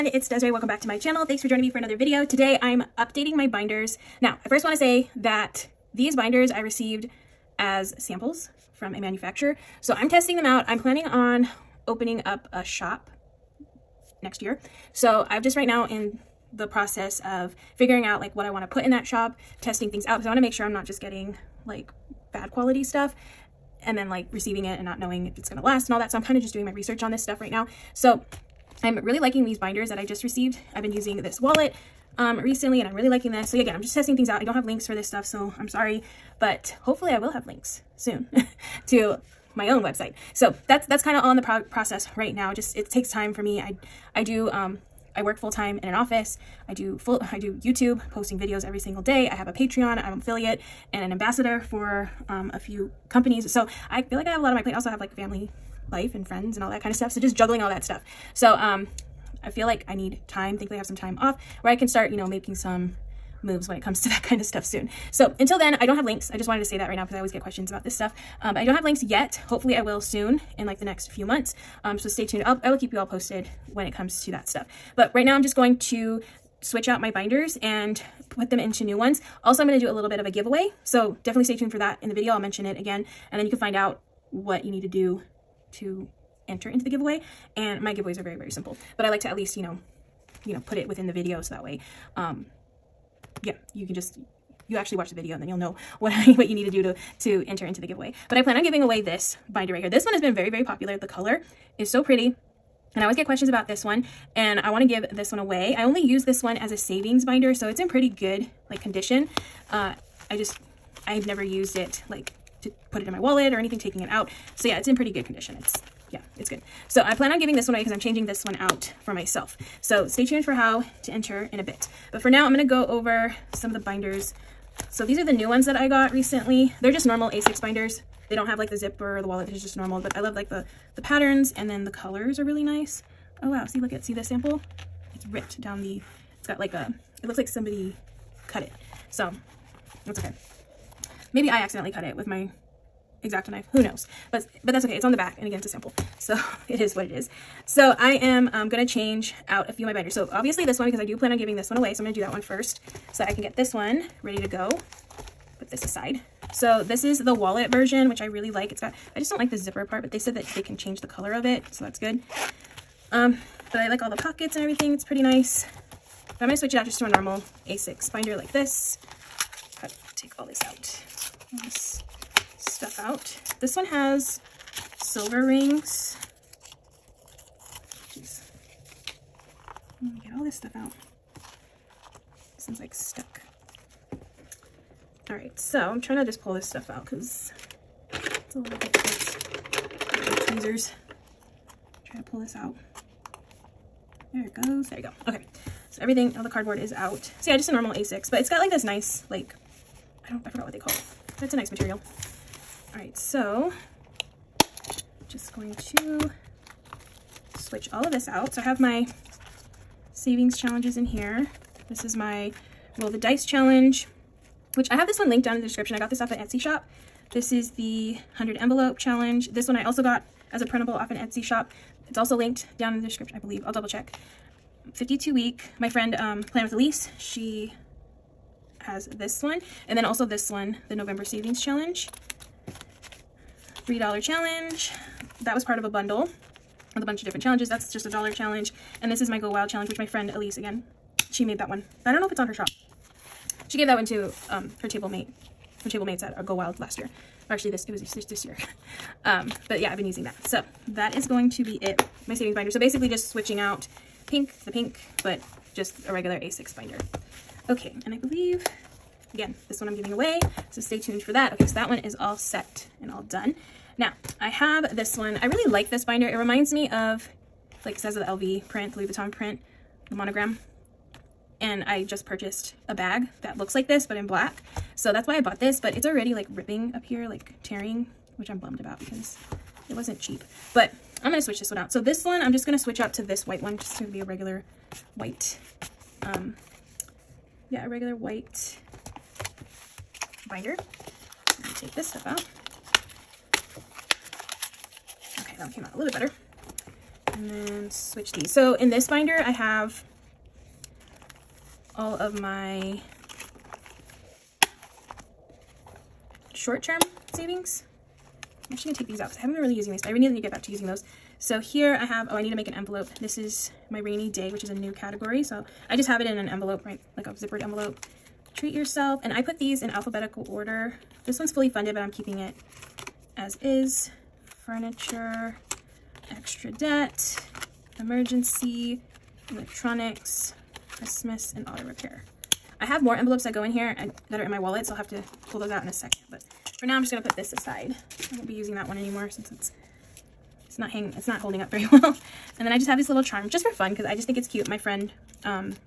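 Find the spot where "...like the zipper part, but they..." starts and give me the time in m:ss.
2:39.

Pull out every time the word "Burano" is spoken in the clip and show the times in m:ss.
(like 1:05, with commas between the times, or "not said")
not said.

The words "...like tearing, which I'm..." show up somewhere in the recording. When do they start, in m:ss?
4:37.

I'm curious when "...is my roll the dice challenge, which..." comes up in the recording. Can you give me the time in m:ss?
3:32.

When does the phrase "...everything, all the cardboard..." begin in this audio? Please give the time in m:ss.
3:16.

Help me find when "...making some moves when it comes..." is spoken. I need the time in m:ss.
1:02.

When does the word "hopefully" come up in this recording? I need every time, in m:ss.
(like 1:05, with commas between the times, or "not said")
0:36, 1:09.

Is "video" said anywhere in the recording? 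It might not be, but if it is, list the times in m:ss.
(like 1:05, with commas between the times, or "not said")
0:01, 0:48, 1:22, 1:31, 1:35.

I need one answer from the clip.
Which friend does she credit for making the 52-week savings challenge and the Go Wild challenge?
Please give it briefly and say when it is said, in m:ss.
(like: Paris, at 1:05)
Plan with Ilysse, at 3:46.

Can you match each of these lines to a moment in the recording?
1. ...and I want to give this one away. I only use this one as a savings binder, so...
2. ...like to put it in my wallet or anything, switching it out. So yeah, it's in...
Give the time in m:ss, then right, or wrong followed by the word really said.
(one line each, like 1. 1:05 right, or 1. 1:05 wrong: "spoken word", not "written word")
1. 1:44 right
2. 1:52 wrong: "taking", not "switching".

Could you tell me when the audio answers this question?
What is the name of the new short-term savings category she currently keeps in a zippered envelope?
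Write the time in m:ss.
5:13.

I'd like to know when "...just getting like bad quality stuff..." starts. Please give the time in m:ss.
0:20.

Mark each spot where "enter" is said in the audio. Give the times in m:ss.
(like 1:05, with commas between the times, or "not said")
1:26, 1:37, 2:01.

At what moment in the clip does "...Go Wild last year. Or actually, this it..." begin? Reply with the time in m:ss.
4:06.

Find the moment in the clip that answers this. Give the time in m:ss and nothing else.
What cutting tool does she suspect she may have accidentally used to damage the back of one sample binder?
2:23.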